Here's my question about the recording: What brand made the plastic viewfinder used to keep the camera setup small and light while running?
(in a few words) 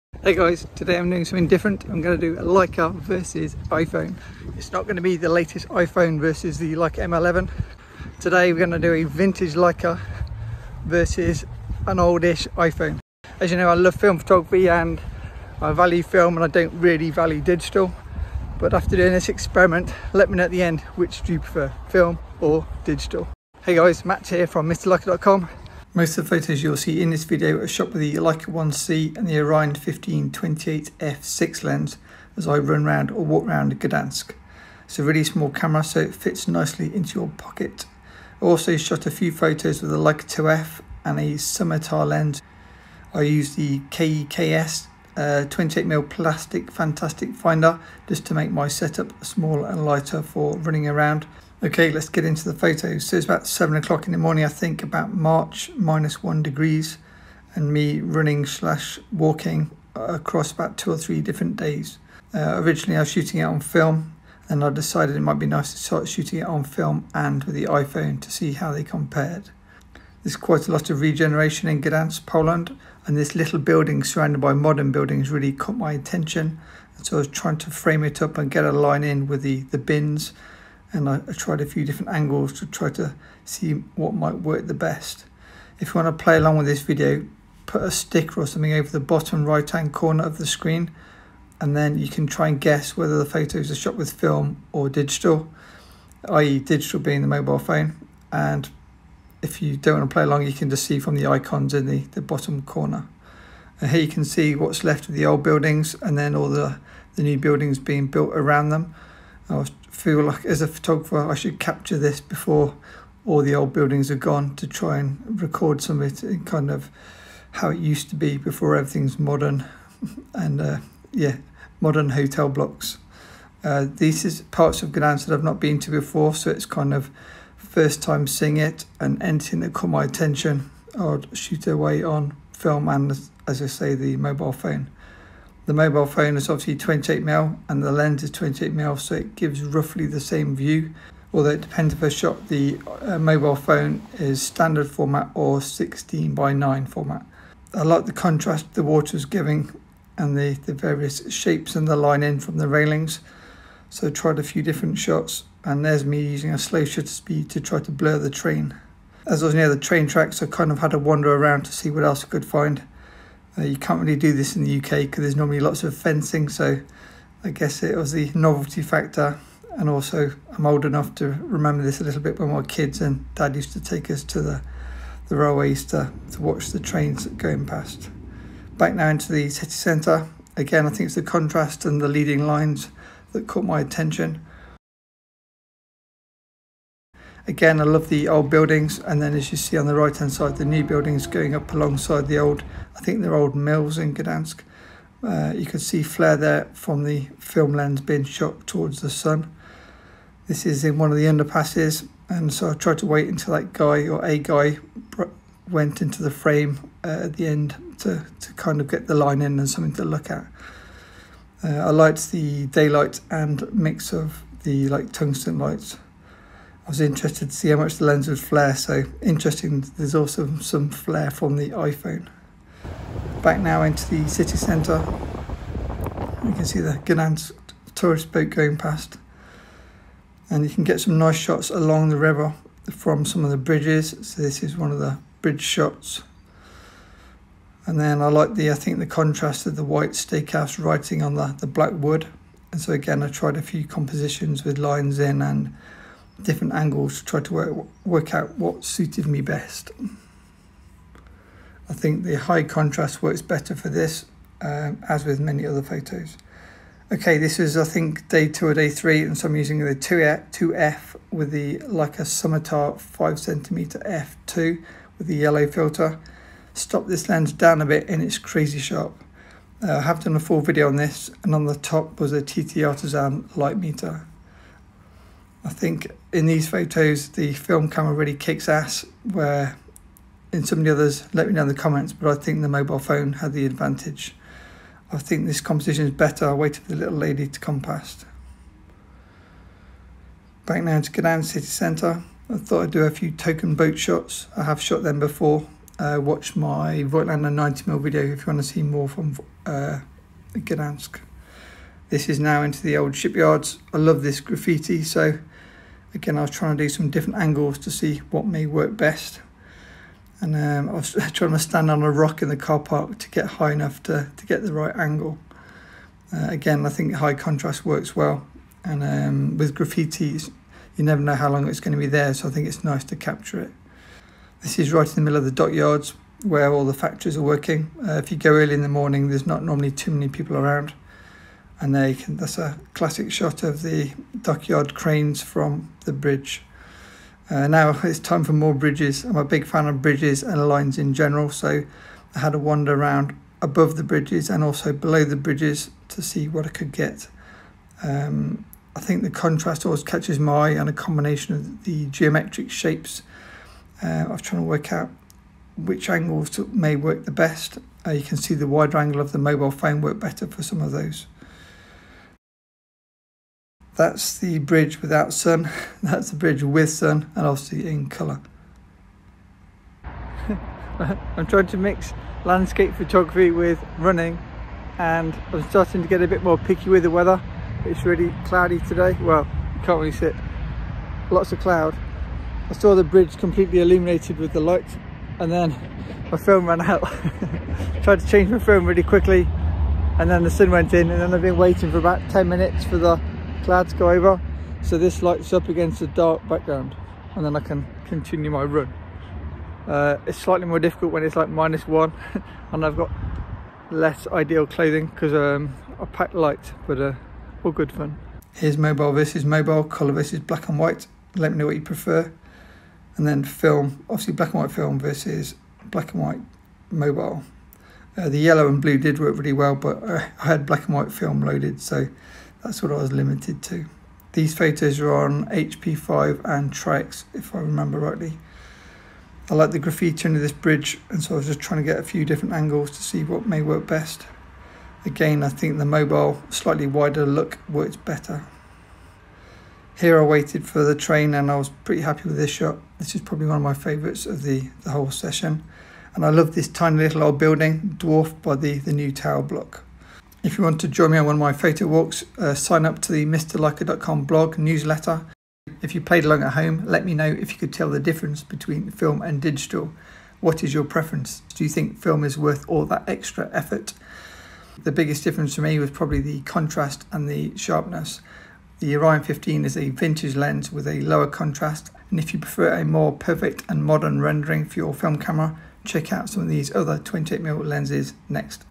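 KEKS.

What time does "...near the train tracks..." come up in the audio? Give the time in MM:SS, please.
02:39.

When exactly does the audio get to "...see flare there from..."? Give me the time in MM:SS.
03:15.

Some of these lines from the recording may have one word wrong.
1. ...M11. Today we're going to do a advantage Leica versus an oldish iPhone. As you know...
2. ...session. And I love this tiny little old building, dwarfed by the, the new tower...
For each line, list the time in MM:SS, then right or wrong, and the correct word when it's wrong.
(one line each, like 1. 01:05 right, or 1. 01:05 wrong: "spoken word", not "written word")
1. 00:06 wrong: "vintage", not "advantage"
2. 07:25 right.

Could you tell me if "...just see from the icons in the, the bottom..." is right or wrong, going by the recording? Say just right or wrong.
right.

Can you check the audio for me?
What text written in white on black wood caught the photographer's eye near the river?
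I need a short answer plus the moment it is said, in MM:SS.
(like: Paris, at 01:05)
steakhouse, at 04:00.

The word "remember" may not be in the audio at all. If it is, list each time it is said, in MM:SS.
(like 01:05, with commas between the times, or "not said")
02:51, 07:07.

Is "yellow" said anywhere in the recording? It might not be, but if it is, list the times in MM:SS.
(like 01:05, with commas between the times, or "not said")
04:25, 06:58.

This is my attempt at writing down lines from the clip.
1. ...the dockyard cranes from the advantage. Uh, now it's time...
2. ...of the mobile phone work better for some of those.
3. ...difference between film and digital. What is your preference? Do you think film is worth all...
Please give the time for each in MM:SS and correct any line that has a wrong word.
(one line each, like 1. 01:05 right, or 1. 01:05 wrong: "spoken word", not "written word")
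1. 05:33 wrong: "bridge", not "advantage"
2. 05:59 right
3. 07:37 right.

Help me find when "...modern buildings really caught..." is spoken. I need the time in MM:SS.
01:14.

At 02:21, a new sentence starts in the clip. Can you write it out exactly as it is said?
Although it depends a shot, the uh, mobile phone is standard format or 16 by 9 format.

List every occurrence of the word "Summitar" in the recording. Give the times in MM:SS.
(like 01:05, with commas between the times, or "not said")
00:41, 04:22.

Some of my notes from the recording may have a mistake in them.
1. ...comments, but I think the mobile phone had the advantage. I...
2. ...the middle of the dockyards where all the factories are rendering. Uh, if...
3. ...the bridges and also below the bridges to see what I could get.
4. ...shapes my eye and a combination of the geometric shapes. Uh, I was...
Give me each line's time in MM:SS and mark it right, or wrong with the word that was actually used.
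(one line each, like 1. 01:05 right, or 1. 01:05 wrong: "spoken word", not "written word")
1. 04:41 right
2. 05:25 wrong: "working", not "rendering"
3. 05:43 right
4. 05:50 wrong: "catches", not "shapes".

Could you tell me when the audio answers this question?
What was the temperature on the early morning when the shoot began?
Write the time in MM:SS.
00:55.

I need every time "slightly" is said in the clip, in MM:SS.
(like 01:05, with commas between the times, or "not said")
06:40, 07:16.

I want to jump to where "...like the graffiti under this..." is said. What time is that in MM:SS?
07:09.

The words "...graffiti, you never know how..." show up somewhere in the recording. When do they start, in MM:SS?
05:19.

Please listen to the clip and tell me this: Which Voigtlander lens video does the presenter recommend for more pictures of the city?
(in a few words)
90mm.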